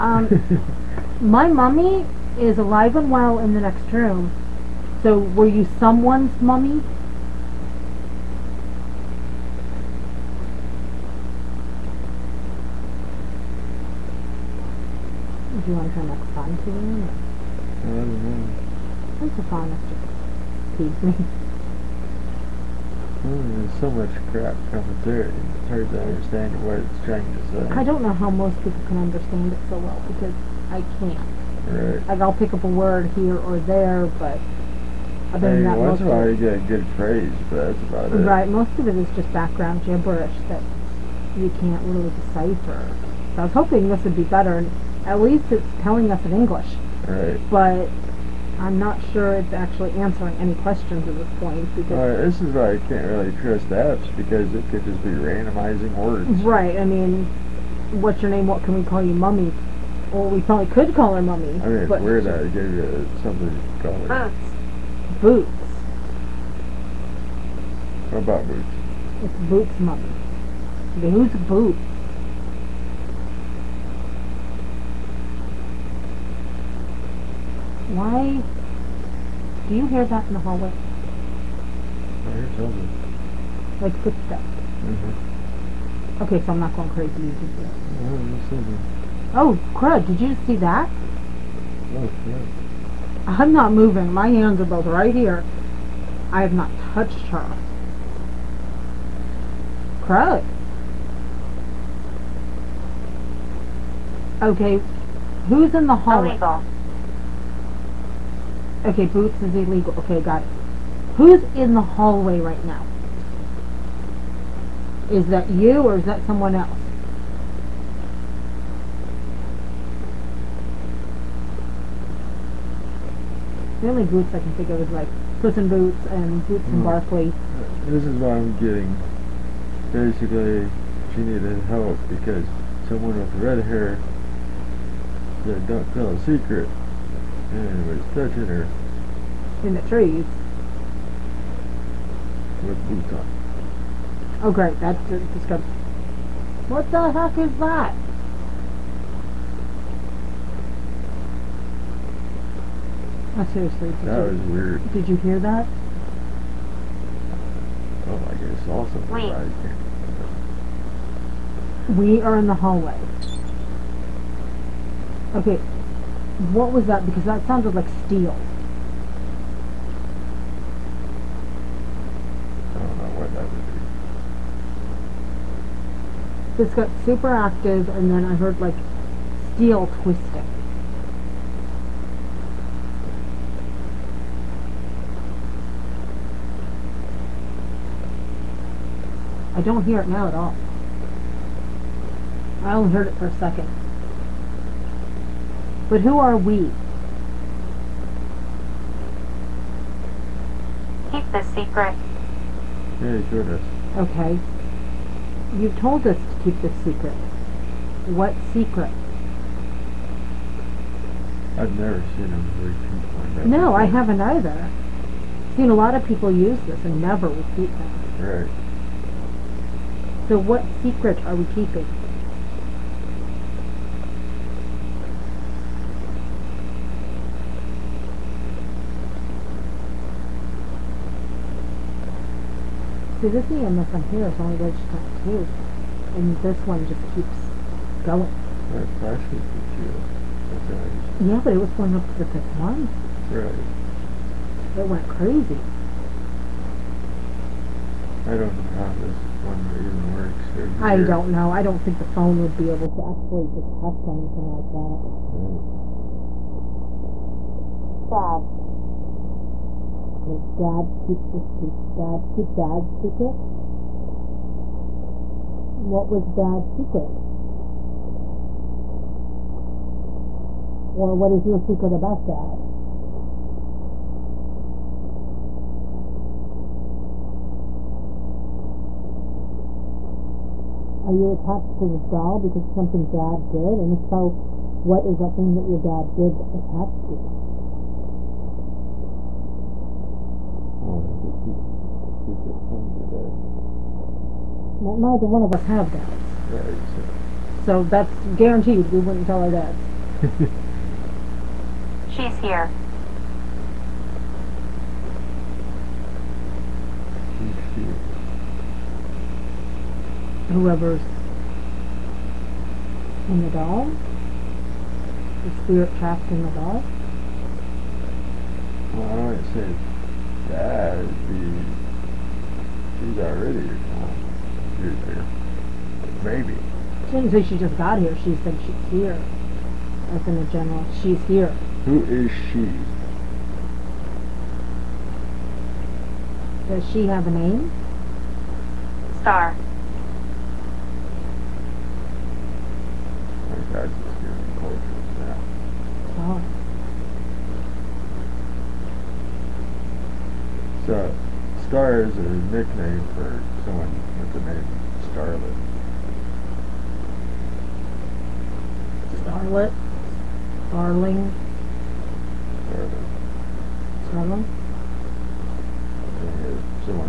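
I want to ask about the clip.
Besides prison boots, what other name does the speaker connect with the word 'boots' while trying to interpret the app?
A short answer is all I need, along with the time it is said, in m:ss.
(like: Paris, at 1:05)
Barclay, at 2:06.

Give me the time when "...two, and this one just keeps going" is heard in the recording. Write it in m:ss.
3:55.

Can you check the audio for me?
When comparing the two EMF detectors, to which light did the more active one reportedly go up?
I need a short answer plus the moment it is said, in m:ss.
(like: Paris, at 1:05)
fifth one, at 4:02.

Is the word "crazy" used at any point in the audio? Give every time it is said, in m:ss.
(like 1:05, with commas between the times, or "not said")
1:26, 4:05.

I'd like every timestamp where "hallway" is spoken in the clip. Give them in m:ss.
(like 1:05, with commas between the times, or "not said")
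1:20, 1:45, 1:51, 2:42.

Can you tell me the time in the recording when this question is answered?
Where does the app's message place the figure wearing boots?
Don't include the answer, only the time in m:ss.
2:19.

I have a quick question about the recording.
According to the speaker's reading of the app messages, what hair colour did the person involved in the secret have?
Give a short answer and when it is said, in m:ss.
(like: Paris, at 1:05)
red, at 2:13.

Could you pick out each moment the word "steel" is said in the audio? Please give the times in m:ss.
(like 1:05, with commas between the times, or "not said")
2:48, 2:59.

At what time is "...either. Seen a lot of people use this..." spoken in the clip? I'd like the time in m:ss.
3:34.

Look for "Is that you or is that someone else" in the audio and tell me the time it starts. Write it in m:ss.
1:55.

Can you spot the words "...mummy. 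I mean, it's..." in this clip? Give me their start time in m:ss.
1:01.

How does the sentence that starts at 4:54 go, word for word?
Well, neither one of us have dads.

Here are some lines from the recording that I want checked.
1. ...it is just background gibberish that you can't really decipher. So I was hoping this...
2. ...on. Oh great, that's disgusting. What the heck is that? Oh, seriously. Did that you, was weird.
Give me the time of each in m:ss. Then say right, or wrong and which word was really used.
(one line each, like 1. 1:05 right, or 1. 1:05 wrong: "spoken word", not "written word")
1. 0:38 right
2. 2:23 right.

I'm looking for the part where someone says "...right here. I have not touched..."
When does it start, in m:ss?
1:34.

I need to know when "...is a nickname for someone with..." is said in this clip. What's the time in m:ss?
5:52.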